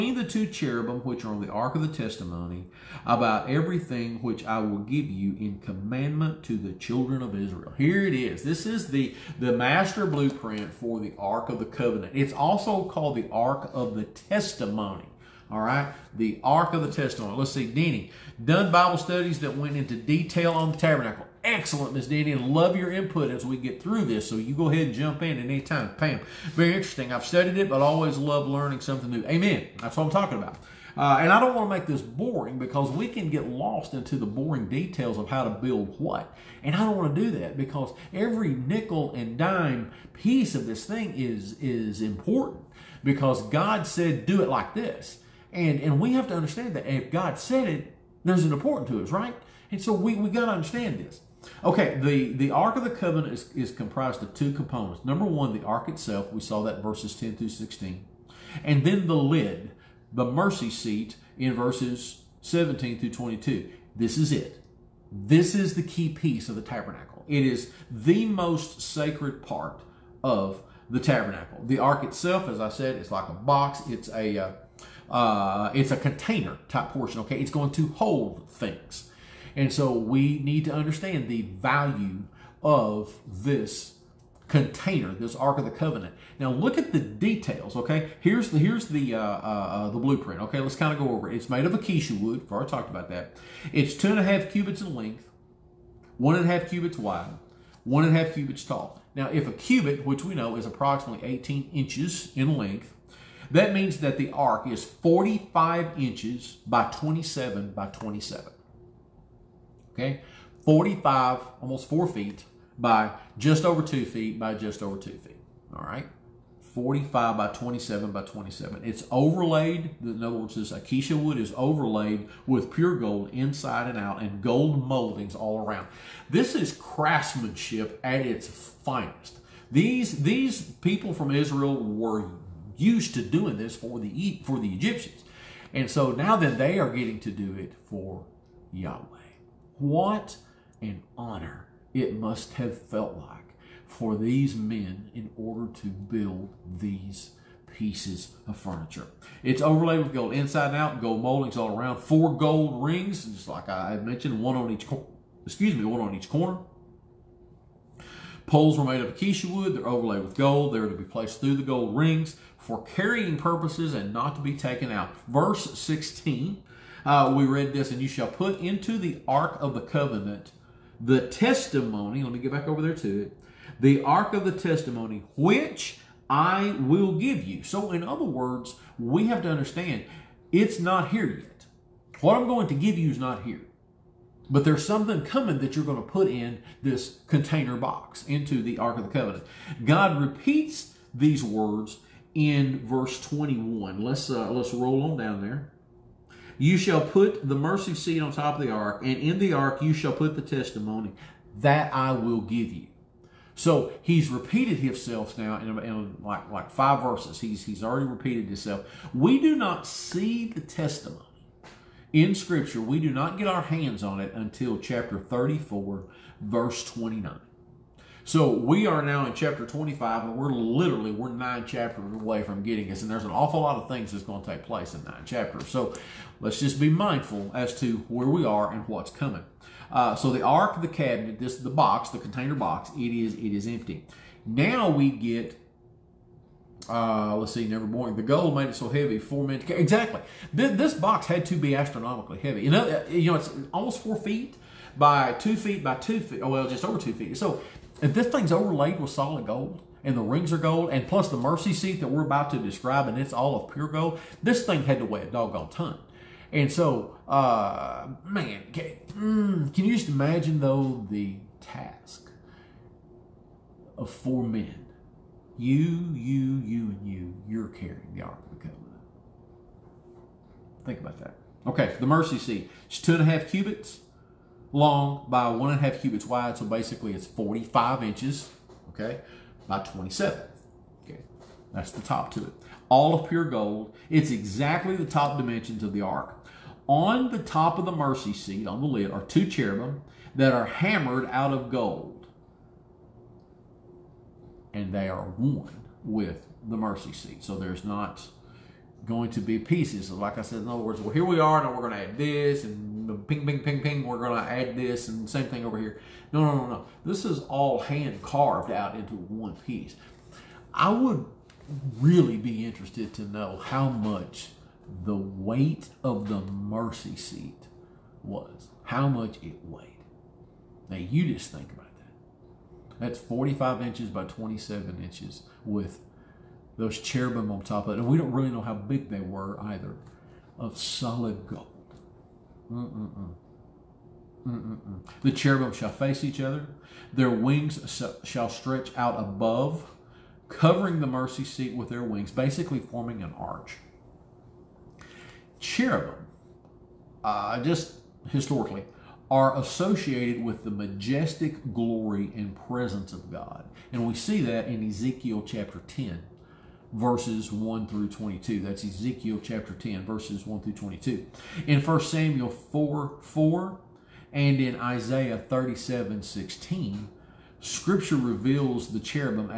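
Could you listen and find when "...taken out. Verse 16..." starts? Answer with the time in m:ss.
2:44.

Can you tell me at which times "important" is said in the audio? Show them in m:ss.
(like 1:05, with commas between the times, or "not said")
0:42, 0:48.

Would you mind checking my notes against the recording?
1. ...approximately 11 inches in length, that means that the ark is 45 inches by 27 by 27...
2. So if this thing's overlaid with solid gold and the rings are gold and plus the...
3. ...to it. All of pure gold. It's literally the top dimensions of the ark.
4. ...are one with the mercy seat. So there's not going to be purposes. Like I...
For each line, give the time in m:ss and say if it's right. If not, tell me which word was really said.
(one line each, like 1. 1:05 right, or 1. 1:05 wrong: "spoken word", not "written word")
1. 1:40 wrong: "18", not "11"
2. 4:07 right
3. 4:42 wrong: "exactly", not "literally"
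4. 4:55 wrong: "pieces", not "purposes".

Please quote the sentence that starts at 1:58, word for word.
It's overlaid, in other words, this acacia wood is overlaid with pure gold inside and out and gold moldings all around.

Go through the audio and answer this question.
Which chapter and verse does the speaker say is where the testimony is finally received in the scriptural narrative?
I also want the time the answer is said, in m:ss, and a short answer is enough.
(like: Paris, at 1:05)
Chapter 34, verse 29, at 3:34.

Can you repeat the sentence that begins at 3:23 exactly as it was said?
So he's repeated himself now in, in like, like five verses.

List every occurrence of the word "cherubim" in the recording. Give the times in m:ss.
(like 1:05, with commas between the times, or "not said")
0:00, 4:49, 5:26, 5:35, 5:45, 6:08.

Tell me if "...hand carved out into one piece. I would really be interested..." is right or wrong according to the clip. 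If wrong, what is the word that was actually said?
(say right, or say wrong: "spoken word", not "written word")
right.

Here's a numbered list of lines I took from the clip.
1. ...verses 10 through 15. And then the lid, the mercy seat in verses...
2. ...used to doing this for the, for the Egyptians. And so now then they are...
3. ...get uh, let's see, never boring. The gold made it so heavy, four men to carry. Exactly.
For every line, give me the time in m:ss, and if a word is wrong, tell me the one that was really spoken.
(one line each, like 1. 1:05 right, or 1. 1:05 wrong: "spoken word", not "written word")
1. 0:56 wrong: "16", not "15"
2. 2:12 right
3. 3:55 right.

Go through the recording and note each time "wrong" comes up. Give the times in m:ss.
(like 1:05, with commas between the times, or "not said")
not said.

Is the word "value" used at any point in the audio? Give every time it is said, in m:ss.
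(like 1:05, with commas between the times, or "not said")
1:21.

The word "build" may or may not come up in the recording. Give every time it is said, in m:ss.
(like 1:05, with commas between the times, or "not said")
0:35, 2:25.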